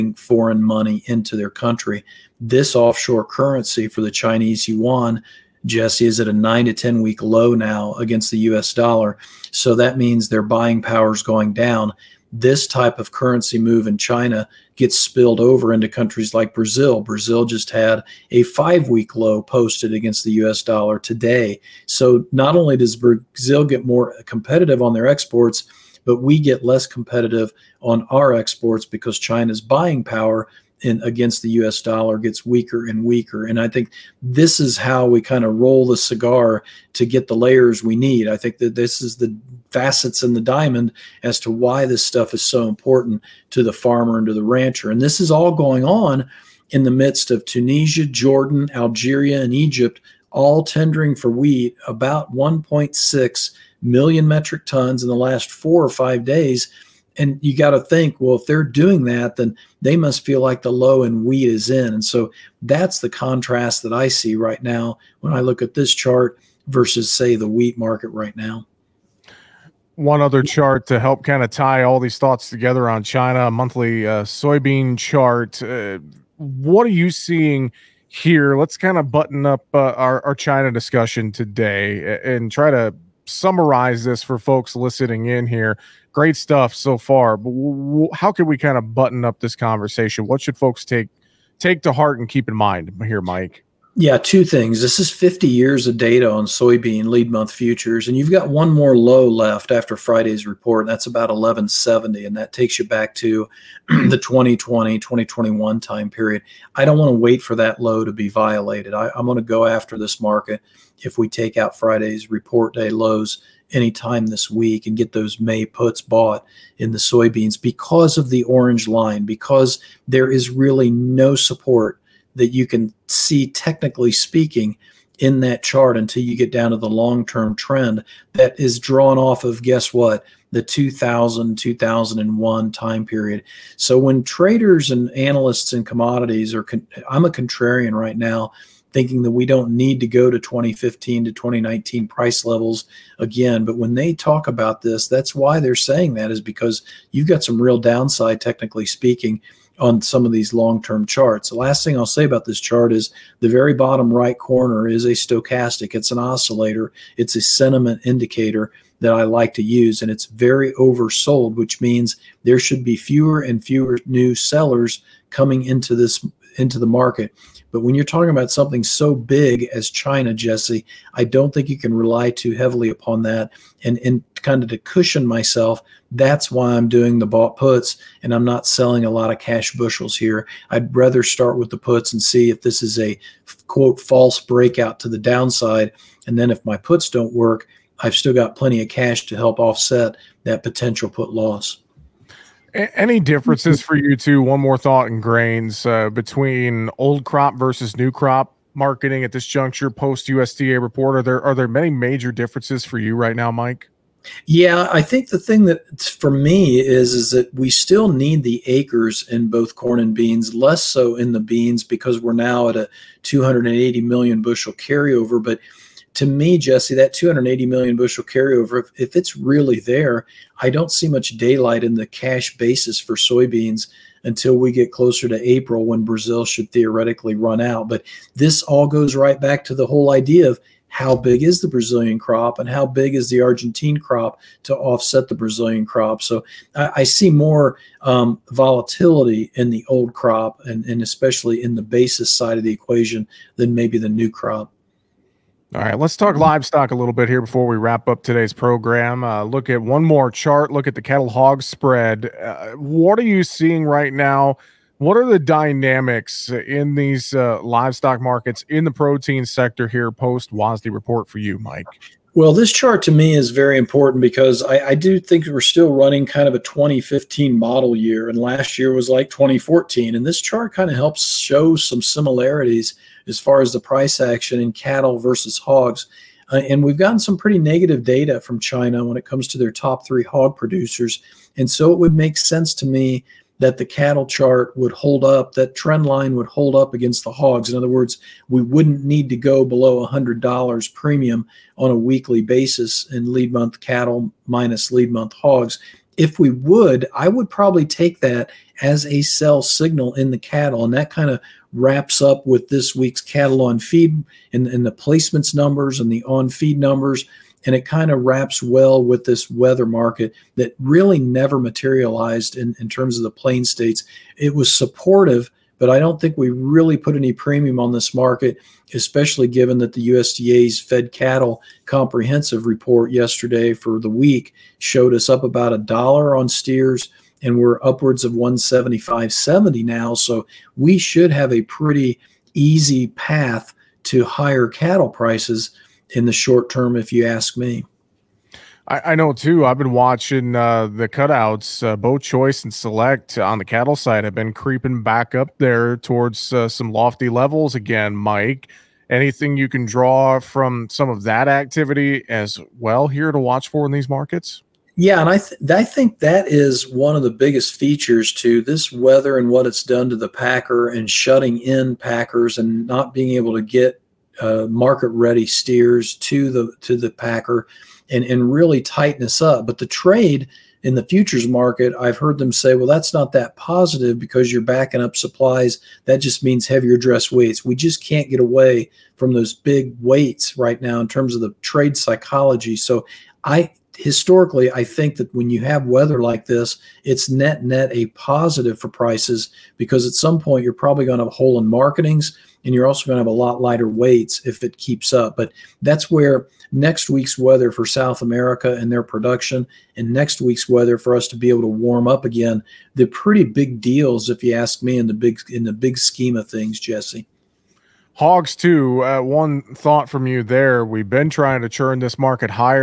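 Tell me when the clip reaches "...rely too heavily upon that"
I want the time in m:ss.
2:51.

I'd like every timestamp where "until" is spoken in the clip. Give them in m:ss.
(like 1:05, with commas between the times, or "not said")
2:05, 3:44.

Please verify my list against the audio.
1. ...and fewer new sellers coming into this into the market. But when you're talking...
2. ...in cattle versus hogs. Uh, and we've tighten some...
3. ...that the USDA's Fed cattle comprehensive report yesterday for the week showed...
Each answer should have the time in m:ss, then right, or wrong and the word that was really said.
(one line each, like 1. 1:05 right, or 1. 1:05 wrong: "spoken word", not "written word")
1. 2:43 right
2. 4:34 wrong: "gotten", not "tighten"
3. 5:19 right.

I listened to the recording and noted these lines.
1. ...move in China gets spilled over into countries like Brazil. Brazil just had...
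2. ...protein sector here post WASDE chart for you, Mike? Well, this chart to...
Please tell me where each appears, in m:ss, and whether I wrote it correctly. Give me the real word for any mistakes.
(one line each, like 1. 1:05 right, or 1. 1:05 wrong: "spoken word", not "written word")
1. 0:13 right
2. 4:18 wrong: "report", not "chart".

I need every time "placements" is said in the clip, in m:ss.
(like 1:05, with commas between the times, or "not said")
5:04.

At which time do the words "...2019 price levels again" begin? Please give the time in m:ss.
2:21.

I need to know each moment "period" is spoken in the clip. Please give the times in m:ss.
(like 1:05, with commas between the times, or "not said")
1:46, 2:13.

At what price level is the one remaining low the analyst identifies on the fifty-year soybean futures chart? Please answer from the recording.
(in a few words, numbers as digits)
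1170.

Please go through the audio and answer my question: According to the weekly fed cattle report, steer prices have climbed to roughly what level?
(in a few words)
175.70.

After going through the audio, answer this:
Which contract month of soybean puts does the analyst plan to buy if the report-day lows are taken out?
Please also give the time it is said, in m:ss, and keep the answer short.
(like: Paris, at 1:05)
May, at 1:55.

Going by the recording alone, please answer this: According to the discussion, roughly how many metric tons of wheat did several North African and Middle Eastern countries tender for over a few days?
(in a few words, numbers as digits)
1.6 million.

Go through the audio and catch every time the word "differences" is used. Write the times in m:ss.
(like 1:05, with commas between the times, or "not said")
3:13, 3:22.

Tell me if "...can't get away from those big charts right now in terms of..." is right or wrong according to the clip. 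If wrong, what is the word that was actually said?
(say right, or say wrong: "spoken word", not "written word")
wrong: "weights", not "charts".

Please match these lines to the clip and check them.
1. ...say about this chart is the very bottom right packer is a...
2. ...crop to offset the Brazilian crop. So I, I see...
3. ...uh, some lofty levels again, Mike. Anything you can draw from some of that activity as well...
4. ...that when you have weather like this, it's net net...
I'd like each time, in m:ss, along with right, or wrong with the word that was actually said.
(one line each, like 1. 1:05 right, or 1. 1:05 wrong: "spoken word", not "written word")
1. 2:32 wrong: "corner", not "packer"
2. 3:53 right
3. 5:46 right
4. 6:25 right.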